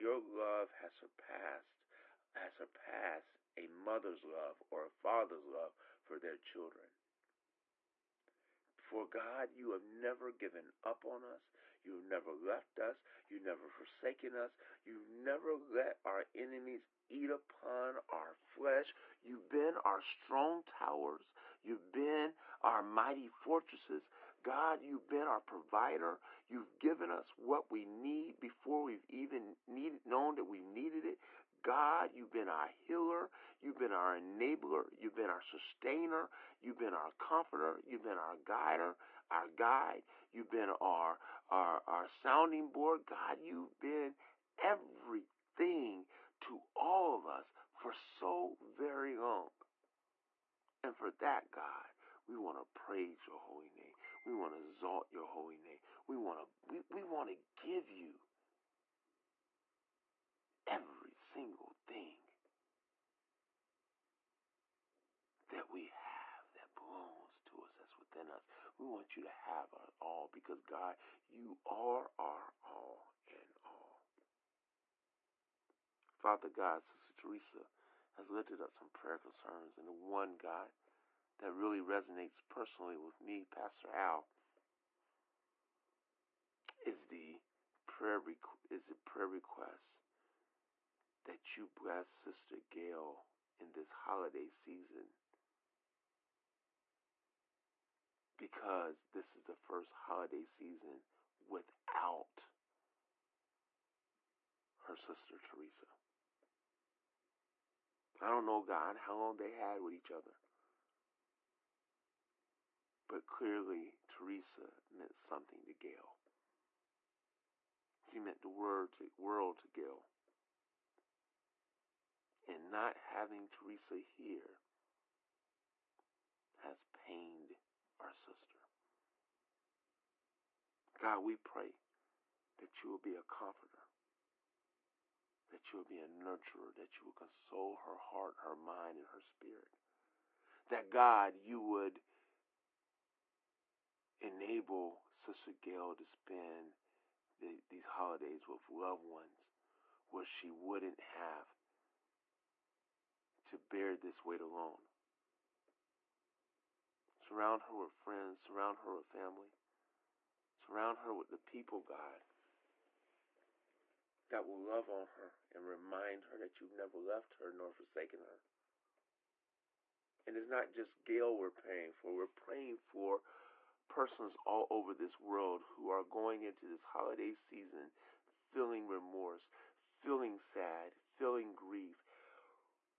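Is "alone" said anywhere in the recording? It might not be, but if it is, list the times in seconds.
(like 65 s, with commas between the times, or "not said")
154 s.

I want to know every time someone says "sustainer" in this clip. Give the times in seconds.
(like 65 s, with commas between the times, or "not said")
35 s.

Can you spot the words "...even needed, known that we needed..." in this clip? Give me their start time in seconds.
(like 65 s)
29 s.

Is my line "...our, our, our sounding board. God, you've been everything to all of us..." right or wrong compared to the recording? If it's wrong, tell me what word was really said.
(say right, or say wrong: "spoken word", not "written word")
right.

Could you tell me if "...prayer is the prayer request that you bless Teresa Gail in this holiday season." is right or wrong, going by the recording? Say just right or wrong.
wrong.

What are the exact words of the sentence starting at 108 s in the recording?
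I don't know, God, how long they had with each other.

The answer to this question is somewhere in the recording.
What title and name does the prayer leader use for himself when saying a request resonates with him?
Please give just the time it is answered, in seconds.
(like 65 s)
83 s.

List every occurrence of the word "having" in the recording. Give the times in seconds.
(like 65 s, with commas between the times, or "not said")
123 s.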